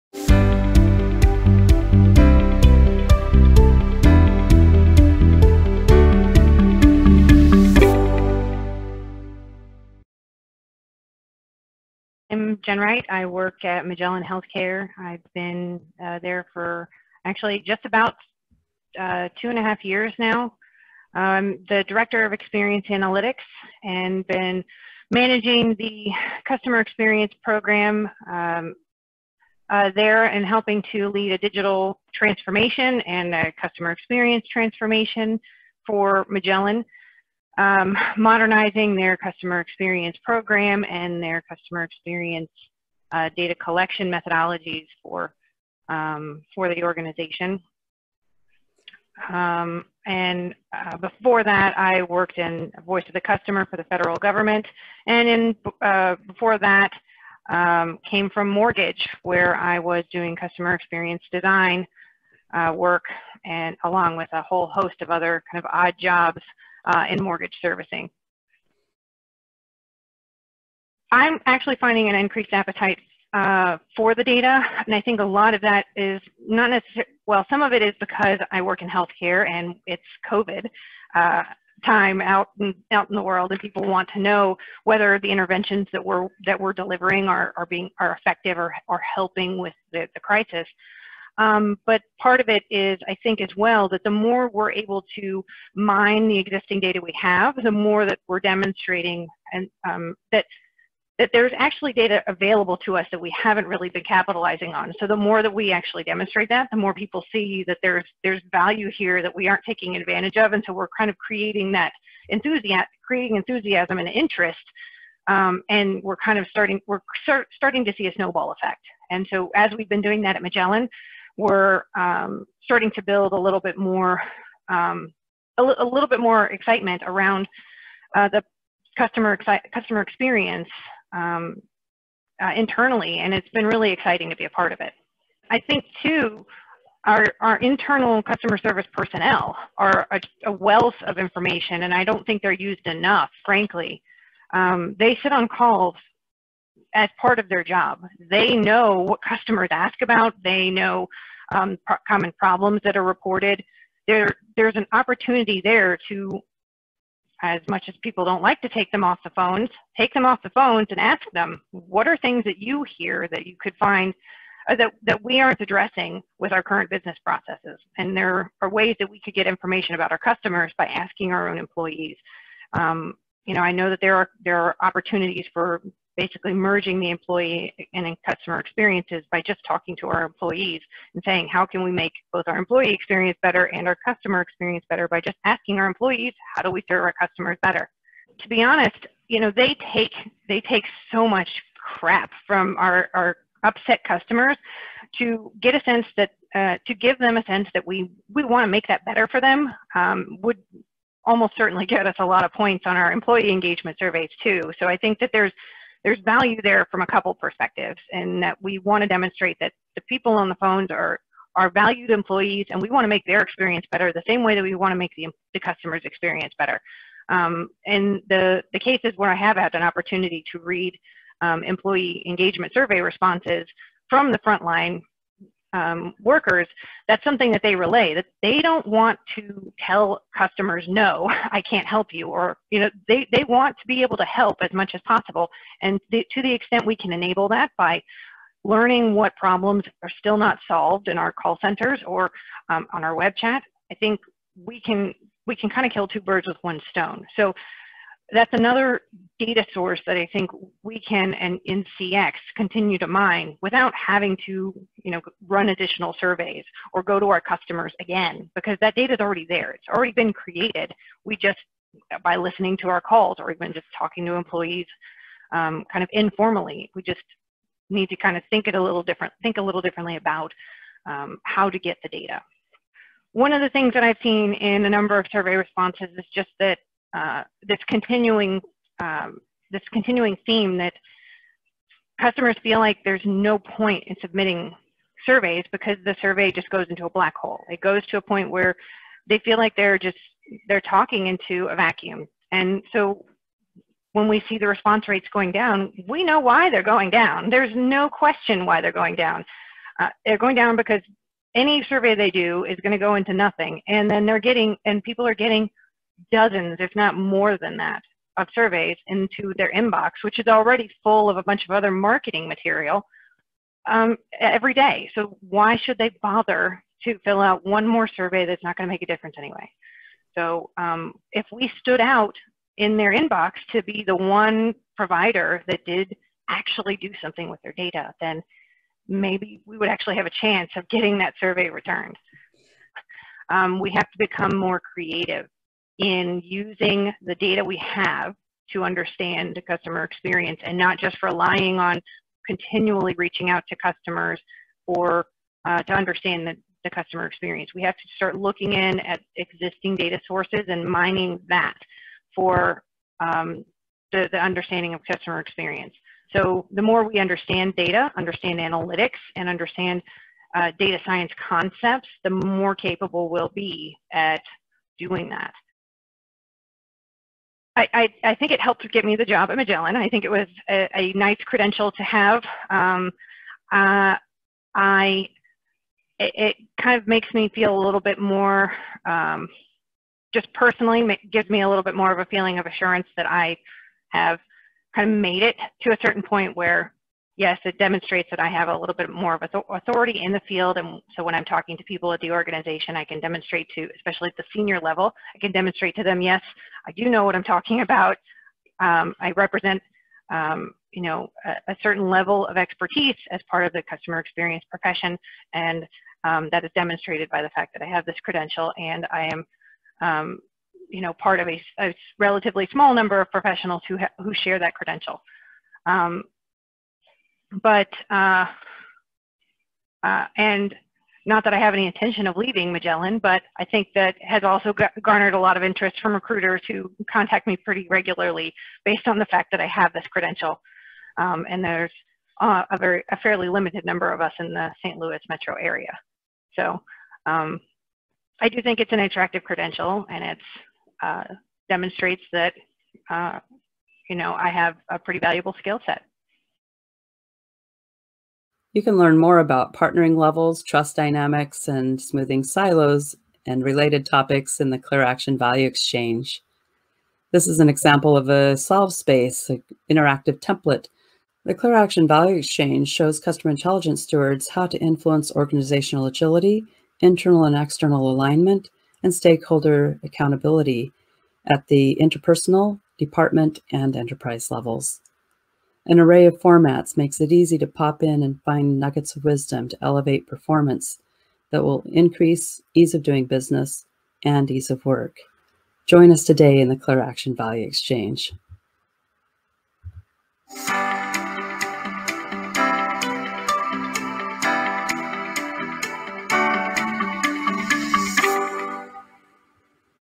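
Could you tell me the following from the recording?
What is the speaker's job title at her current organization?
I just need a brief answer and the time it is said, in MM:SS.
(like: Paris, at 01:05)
Director of Experience Analytics, at 00:21.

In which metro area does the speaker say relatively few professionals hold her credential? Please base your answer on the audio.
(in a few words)
St. Louis.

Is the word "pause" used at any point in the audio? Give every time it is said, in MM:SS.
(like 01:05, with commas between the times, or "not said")
not said.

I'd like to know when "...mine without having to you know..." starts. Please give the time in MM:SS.
04:13.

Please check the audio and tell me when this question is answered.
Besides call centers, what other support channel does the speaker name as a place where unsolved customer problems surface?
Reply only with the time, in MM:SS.
04:03.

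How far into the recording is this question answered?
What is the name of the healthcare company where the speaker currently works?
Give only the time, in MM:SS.
00:13.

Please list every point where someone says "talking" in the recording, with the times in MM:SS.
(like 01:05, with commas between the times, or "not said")
02:59, 04:23, 04:50, 06:31, 06:37.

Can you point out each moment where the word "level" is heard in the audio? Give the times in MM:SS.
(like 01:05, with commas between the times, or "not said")
06:34, 06:42, 07:30, 07:54.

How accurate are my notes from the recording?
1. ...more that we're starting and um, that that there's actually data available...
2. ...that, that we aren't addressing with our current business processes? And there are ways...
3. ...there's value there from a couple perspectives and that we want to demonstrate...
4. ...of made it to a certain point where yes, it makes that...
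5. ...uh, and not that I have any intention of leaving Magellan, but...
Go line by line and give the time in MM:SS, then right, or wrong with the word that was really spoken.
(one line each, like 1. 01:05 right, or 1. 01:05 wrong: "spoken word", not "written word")
1. 01:37 wrong: "demonstrating", not "starting"
2. 02:44 right
3. 03:26 right
4. 06:25 wrong: "demonstrates", not "makes"
5. 07:00 right.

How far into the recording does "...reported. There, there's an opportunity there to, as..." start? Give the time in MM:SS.
02:33.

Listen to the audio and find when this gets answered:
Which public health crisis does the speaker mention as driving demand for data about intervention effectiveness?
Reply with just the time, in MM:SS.
01:20.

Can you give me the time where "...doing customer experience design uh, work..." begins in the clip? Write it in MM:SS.
01:00.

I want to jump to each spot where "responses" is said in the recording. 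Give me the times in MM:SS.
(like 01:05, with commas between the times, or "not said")
03:43, 04:35, 04:54.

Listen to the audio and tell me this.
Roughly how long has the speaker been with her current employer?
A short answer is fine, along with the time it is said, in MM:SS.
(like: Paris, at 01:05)
2 and a half years, at 00:19.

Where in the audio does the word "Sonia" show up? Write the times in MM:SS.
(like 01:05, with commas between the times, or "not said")
not said.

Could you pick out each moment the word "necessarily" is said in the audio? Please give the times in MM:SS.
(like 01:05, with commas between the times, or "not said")
01:16.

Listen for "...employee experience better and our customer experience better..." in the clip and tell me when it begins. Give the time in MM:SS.
03:02.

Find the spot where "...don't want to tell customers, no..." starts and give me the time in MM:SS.
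03:48.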